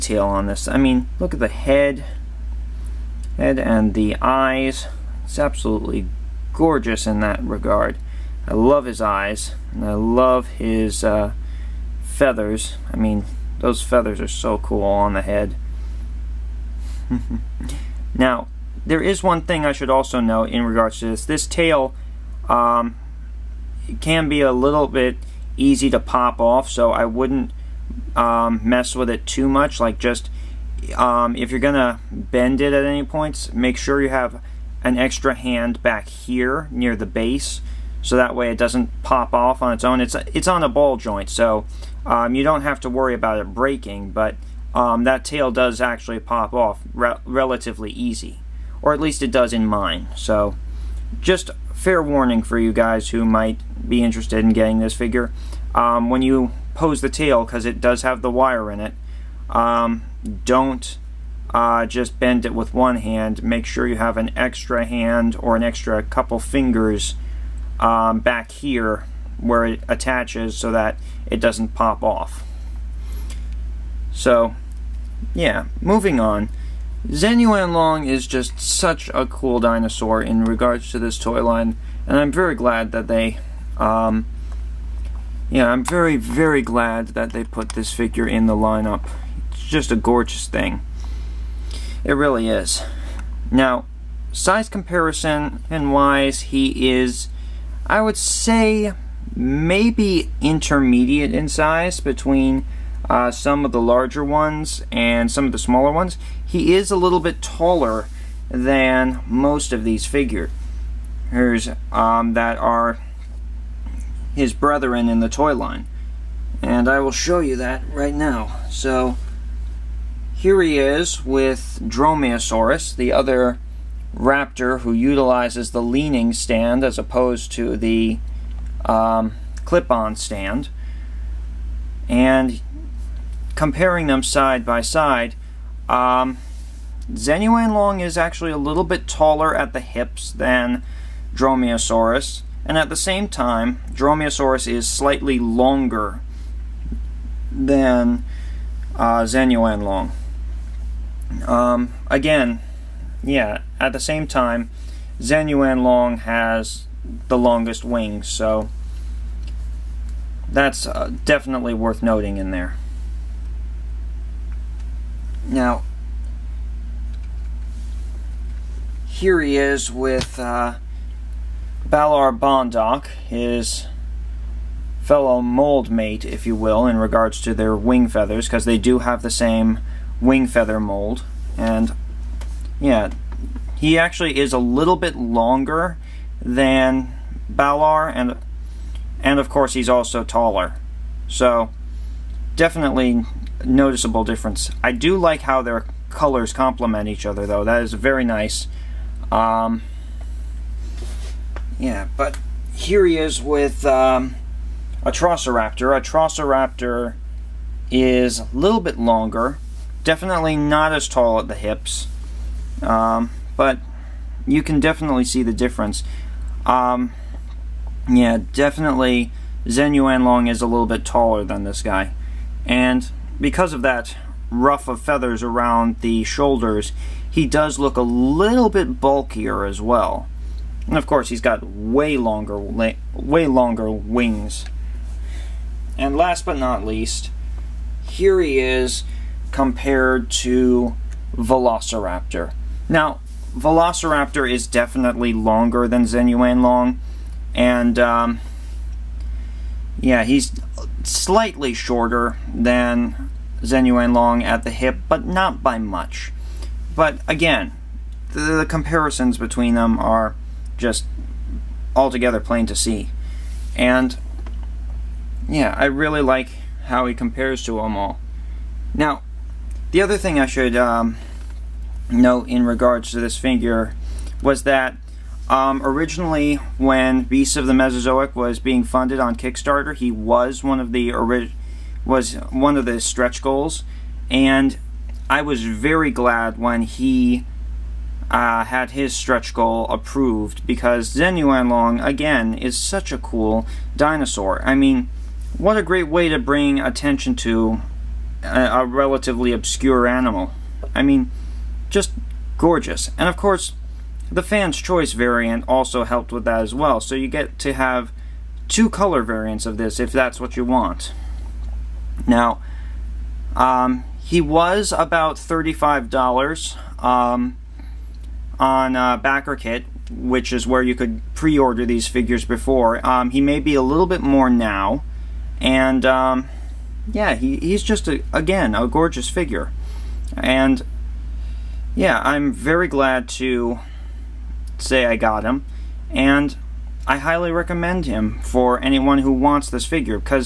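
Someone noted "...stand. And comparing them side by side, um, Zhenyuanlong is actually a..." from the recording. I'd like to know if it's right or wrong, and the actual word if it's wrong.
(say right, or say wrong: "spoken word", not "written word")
right.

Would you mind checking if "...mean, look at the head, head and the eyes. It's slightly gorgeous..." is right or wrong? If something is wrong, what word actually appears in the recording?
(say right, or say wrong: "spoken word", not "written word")
wrong: "absolutely", not "slightly".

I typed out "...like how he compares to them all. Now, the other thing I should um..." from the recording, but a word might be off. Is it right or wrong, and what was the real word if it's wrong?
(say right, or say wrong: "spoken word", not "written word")
right.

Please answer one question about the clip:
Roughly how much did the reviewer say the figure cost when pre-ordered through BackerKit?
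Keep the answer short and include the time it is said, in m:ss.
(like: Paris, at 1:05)
$35, at 5:15.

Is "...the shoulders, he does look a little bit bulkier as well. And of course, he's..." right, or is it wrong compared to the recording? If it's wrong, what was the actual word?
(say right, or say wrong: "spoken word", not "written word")
right.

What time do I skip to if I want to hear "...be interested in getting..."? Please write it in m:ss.
0:53.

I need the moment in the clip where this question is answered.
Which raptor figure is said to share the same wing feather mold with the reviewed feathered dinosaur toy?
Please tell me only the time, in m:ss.
2:51.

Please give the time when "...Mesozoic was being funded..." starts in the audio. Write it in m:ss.
4:37.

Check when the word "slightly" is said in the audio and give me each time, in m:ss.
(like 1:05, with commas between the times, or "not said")
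2:24, 4:11.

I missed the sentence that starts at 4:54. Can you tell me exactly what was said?
I mean, what a great way to bring attention to a, a relatively obscure animal.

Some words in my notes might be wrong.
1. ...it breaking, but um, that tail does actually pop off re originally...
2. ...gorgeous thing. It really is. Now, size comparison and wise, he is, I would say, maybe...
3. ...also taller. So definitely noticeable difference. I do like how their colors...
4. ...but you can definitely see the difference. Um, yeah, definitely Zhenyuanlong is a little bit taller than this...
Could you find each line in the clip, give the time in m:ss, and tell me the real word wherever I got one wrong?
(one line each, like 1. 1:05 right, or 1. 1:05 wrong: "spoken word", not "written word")
1. 0:43 wrong: "relatively", not "originally"
2. 1:29 right
3. 3:09 right
4. 3:33 right.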